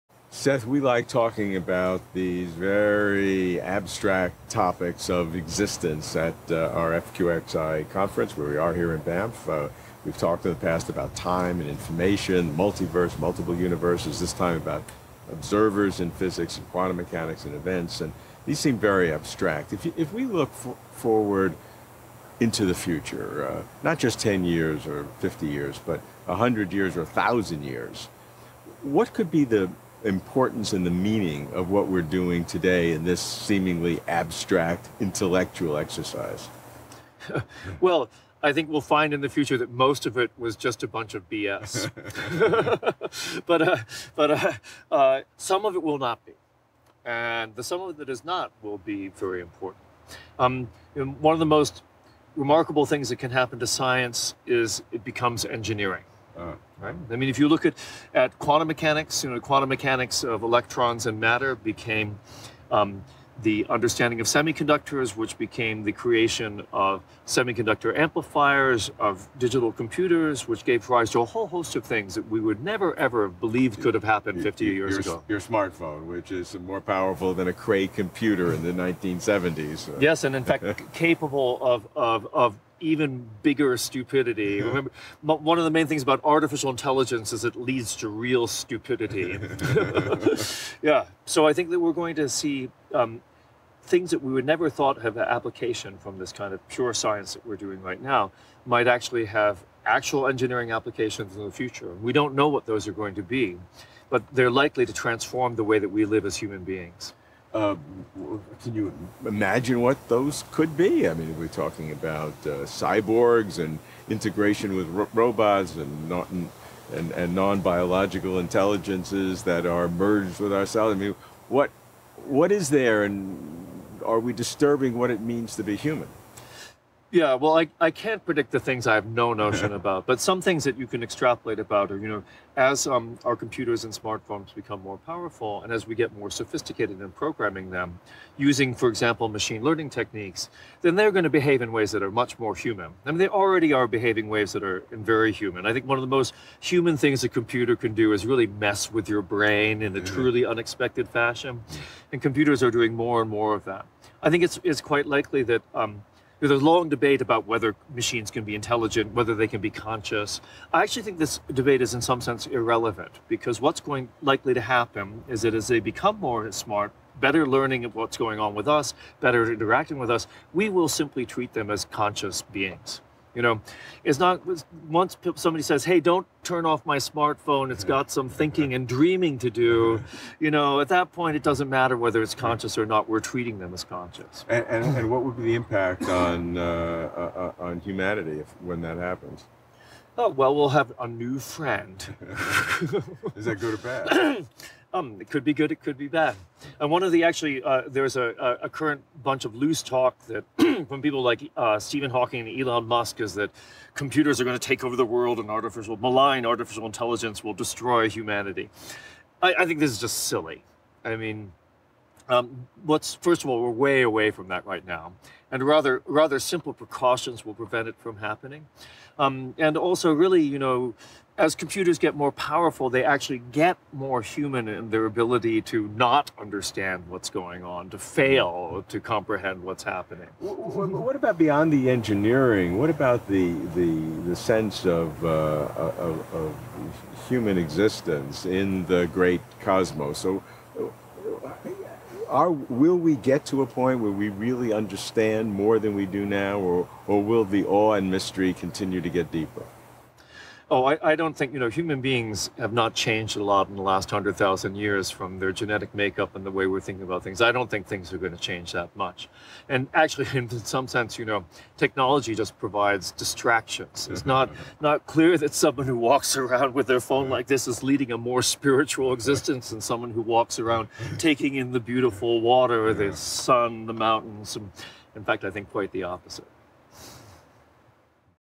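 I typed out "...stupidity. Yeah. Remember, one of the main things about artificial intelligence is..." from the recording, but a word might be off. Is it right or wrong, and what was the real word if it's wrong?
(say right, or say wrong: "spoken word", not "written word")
right.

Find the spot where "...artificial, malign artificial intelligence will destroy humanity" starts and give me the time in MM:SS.
03:25.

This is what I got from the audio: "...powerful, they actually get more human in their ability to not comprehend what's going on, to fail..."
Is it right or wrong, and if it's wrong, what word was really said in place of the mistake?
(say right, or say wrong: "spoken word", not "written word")
wrong: "understand", not "comprehend".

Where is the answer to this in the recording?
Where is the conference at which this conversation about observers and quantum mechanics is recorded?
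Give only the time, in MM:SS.
00:09.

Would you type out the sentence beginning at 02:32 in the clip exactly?
And computers are doing more and more of that.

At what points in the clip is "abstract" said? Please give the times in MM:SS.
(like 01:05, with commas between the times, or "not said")
00:03, 00:19, 00:34.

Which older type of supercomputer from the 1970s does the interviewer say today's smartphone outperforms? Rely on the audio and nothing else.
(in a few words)
Cray computer.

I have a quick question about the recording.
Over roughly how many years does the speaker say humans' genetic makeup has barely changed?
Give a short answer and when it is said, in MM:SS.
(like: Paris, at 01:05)
100,000 years, at 04:14.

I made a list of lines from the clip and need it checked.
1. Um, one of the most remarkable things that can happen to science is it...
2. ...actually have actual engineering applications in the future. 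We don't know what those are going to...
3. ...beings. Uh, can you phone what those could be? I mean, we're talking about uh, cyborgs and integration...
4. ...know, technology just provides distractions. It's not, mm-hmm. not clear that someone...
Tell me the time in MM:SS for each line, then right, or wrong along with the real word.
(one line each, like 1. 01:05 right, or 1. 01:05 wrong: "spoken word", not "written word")
1. 00:50 right
2. 01:38 right
3. 01:46 wrong: "imagine", not "phone"
4. 04:21 right.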